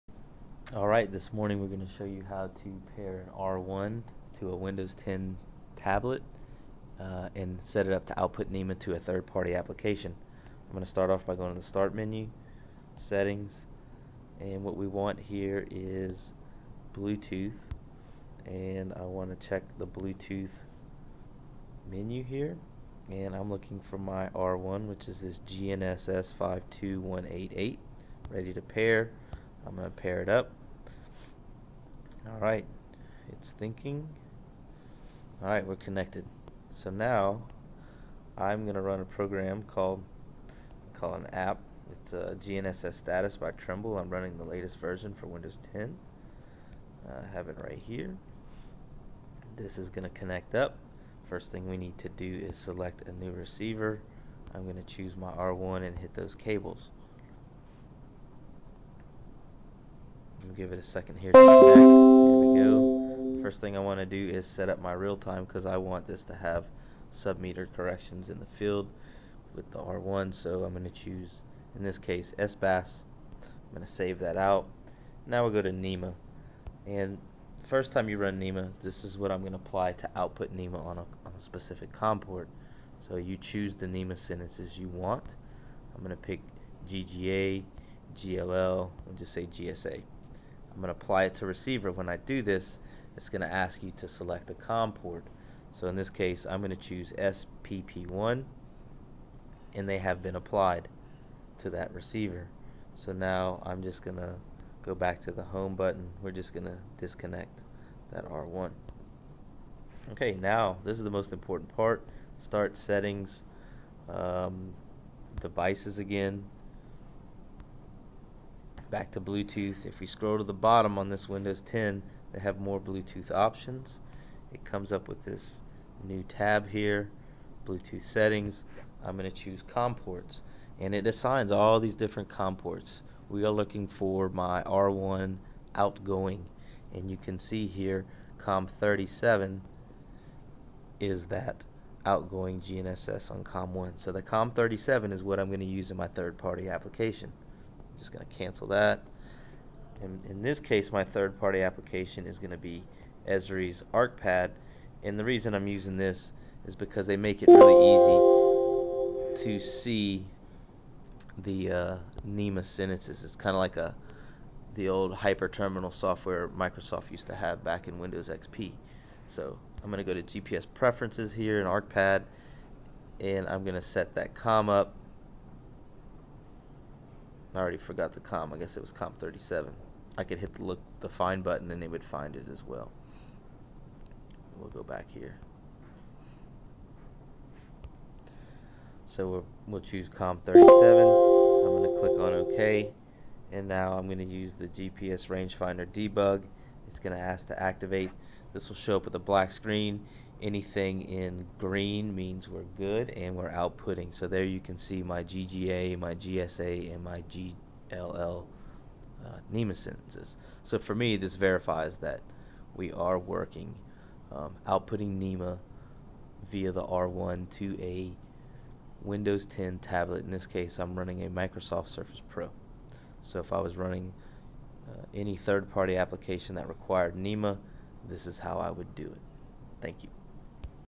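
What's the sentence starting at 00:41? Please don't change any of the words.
It's a GNSS status by Trimble.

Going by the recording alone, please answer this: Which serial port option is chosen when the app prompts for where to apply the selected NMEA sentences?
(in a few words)
SPP1.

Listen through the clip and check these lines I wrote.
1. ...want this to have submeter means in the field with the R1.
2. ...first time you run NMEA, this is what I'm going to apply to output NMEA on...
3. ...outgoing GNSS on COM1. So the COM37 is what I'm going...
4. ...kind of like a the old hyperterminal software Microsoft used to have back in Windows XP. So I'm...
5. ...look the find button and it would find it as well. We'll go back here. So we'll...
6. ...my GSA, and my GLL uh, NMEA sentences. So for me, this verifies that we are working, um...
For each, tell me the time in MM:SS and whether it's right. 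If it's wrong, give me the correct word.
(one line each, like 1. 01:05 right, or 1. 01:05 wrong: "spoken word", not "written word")
1. 01:05 wrong: "corrections", not "means"
2. 01:17 right
3. 02:22 right
4. 02:43 right
5. 03:00 right
6. 03:25 right.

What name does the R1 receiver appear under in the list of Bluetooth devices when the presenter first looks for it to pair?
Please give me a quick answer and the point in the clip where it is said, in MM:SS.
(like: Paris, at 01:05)
GNSS 52188, at 00:25.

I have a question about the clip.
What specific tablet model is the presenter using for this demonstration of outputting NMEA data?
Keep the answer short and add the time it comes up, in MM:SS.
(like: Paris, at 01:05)
Microsoft Surface Pro, at 03:41.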